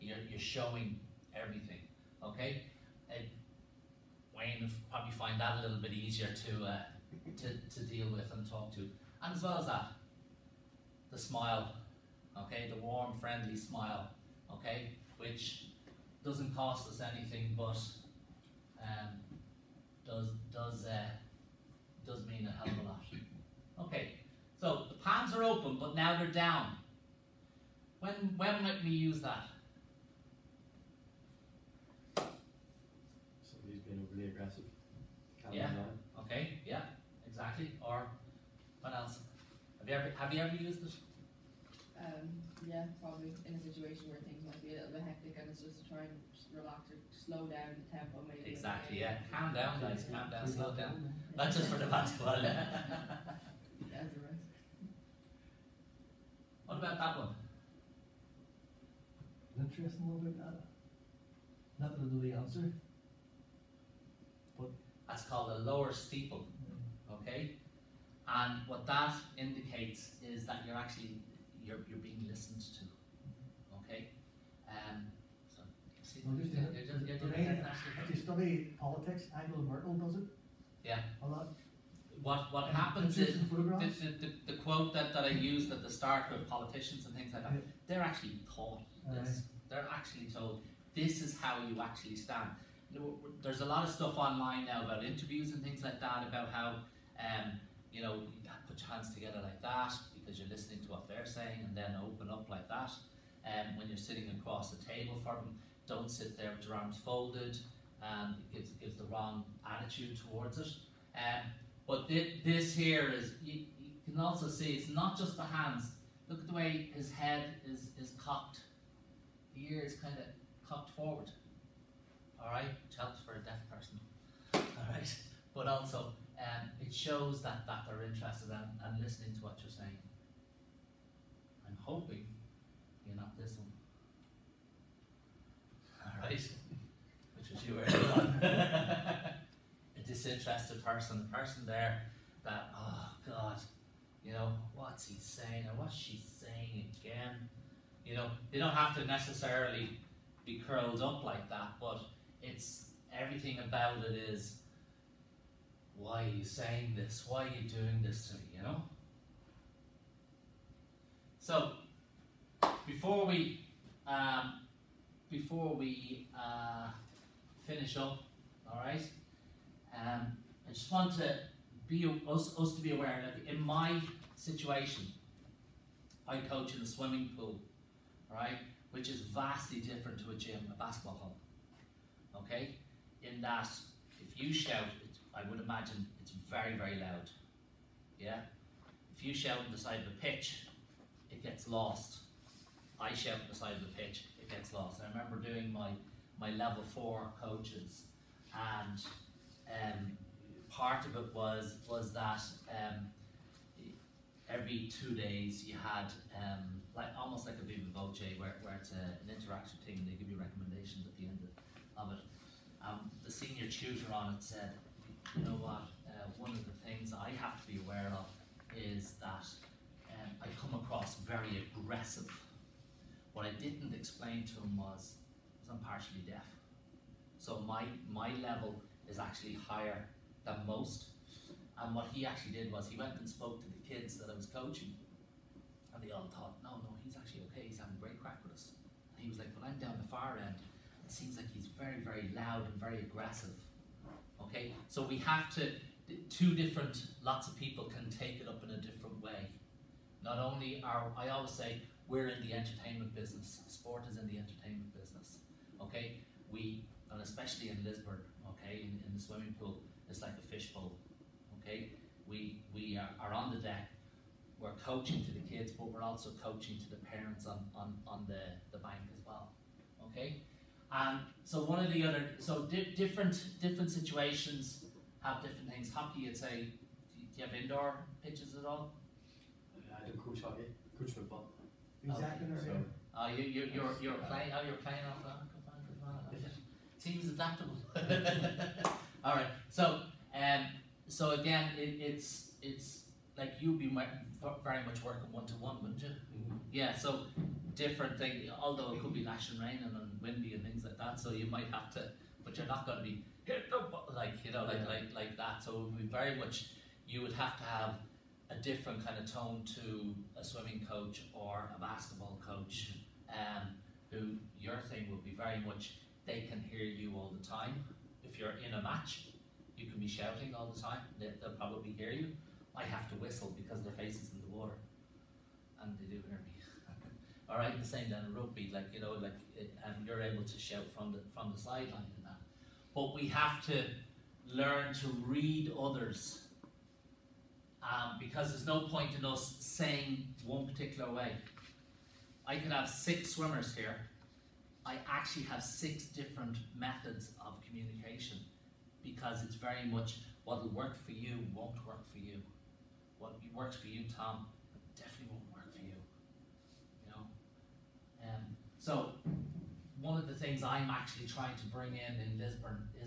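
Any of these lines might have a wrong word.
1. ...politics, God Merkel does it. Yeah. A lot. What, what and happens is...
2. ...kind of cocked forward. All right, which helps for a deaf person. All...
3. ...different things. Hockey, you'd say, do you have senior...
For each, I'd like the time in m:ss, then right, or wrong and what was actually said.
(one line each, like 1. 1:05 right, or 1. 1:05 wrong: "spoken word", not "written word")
1. 1:18 wrong: "Angela", not "God"
2. 1:59 right
3. 4:35 wrong: "indoor", not "senior".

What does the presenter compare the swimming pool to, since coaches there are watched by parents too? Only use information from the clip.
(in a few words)
a fishbowl.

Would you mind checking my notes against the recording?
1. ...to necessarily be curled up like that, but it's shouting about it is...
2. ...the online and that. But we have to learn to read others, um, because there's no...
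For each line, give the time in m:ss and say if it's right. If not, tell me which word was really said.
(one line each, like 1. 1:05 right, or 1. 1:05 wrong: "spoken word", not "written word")
1. 2:28 wrong: "everything", not "shouting"
2. 5:31 wrong: "sideline", not "online".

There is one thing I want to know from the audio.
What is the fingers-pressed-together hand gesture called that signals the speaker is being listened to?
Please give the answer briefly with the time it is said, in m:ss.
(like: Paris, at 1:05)
lower steeple, at 1:05.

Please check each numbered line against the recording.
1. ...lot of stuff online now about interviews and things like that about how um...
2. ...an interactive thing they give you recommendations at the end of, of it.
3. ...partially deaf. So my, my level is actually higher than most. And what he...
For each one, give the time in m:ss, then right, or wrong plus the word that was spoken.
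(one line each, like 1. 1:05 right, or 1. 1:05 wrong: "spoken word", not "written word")
1. 1:33 right
2. 3:29 right
3. 3:45 right.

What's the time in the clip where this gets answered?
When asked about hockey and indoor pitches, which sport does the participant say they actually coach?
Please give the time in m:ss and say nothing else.
4:41.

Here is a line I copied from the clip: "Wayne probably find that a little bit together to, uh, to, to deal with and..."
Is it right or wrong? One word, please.
wrong.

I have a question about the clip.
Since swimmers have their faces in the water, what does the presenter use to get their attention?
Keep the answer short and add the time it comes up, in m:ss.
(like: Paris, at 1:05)
whistle, at 5:23.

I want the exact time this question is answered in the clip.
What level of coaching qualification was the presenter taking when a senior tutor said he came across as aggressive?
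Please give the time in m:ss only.
3:16.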